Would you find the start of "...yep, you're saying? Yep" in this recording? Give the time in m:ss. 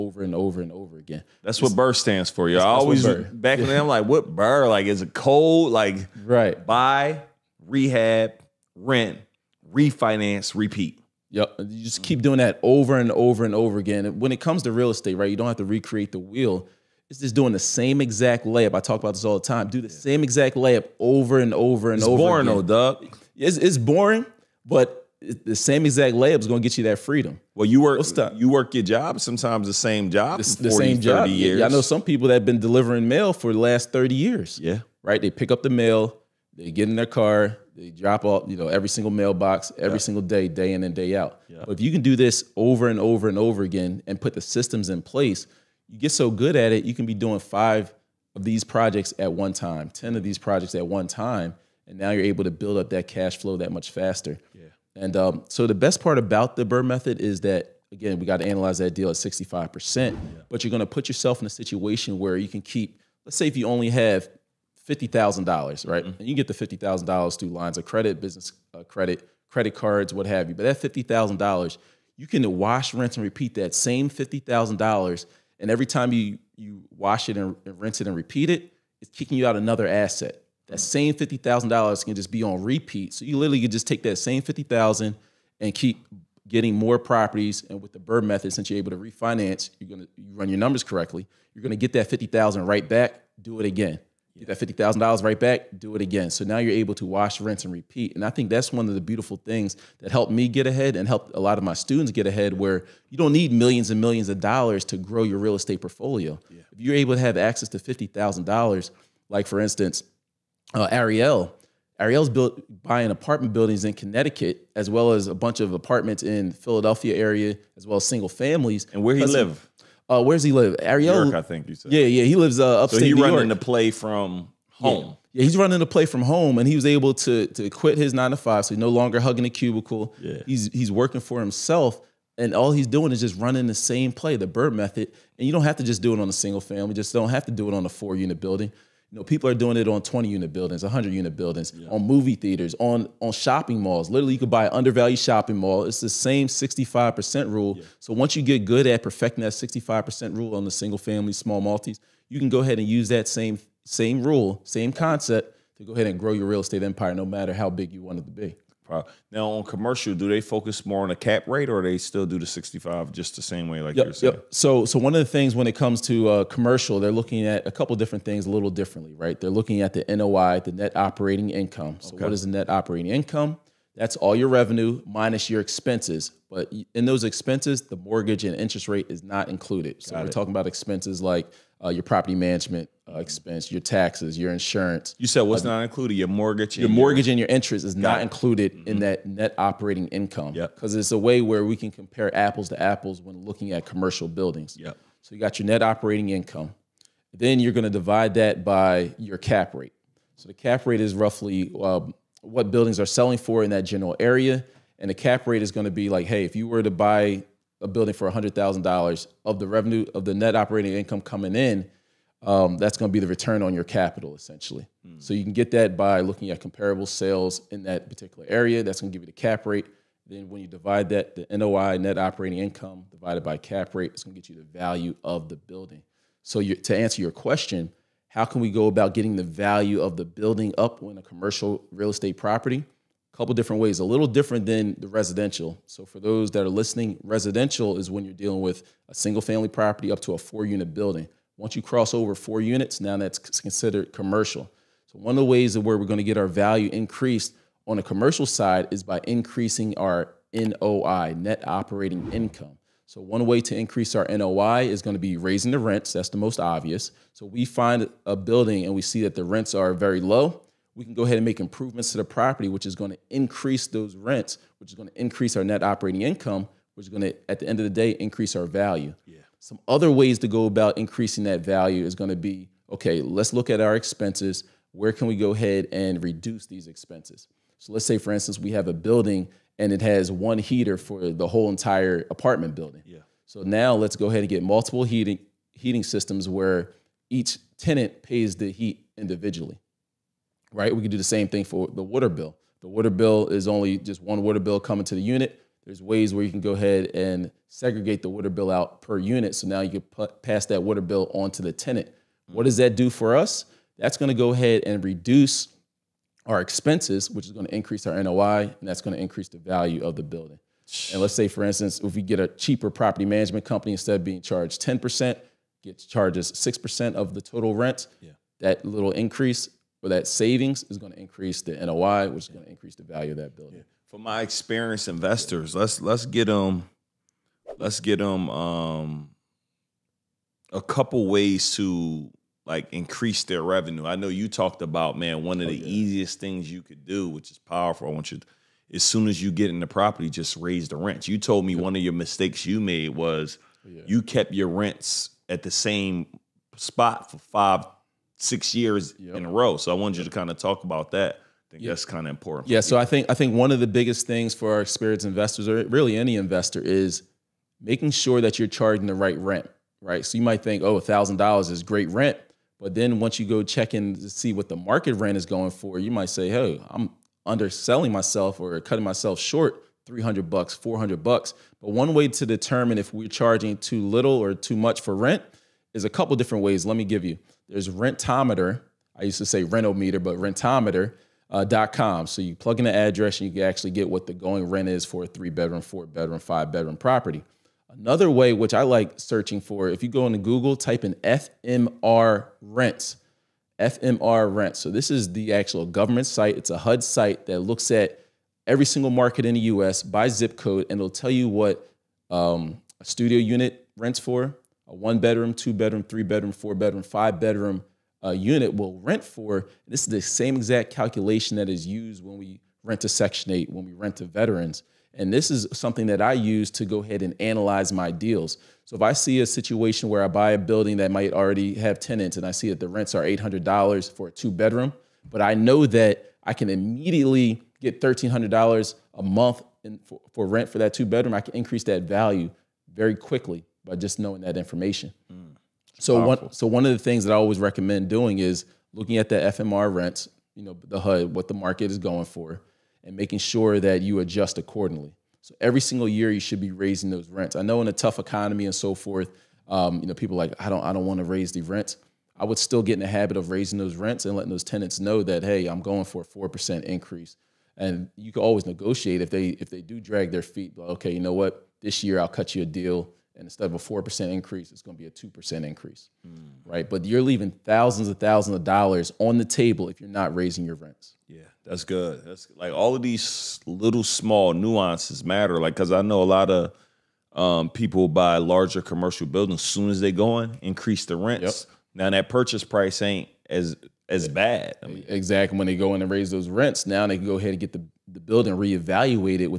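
2:43.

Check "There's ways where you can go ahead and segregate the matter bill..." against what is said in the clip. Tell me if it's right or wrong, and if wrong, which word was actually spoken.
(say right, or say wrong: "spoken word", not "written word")
wrong: "water", not "matter".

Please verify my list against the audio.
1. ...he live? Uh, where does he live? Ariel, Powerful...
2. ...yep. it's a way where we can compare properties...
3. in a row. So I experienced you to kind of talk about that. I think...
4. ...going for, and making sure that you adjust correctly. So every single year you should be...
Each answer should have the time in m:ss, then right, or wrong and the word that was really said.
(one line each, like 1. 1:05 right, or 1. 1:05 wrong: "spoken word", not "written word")
1. 1:59 wrong: "York", not "Powerful"
2. 3:10 wrong: "apples", not "properties"
3. 5:49 wrong: "wanted", not "experienced"
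4. 7:21 wrong: "accordingly", not "correctly".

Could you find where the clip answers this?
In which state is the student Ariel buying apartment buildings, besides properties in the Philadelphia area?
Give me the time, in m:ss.
1:53.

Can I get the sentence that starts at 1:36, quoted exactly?
So now you're able to wash, rinse, and repeat.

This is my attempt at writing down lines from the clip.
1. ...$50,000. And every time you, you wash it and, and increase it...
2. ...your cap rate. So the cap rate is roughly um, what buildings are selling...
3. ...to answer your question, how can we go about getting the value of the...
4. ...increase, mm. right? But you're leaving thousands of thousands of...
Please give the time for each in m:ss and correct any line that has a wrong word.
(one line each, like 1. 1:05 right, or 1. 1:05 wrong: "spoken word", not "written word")
1. 1:14 wrong: "rinse", not "increase"
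2. 3:19 right
3. 3:46 right
4. 7:45 right.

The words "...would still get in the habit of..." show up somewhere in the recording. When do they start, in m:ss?
7:32.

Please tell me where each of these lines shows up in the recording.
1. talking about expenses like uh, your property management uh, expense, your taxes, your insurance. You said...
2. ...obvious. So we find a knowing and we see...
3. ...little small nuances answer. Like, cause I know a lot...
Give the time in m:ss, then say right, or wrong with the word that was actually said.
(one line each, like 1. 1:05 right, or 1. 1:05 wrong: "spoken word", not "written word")
1. 3:00 right
2. 4:16 wrong: "building", not "knowing"
3. 7:53 wrong: "matter", not "answer".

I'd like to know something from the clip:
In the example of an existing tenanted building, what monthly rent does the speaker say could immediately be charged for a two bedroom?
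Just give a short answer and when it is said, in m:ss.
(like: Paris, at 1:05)
$1,300, at 7:08.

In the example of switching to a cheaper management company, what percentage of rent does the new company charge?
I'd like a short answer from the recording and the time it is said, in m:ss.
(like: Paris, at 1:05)
6%, at 5:16.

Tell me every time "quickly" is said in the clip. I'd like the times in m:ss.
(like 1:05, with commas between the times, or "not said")
7:13.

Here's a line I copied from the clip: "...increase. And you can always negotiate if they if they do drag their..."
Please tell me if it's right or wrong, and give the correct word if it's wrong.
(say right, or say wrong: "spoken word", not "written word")
right.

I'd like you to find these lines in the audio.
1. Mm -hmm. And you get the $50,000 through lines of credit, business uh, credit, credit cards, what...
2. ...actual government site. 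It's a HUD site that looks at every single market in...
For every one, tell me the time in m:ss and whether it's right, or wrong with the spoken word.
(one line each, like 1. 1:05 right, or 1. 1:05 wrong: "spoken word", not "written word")
1. 1:06 right
2. 6:35 right.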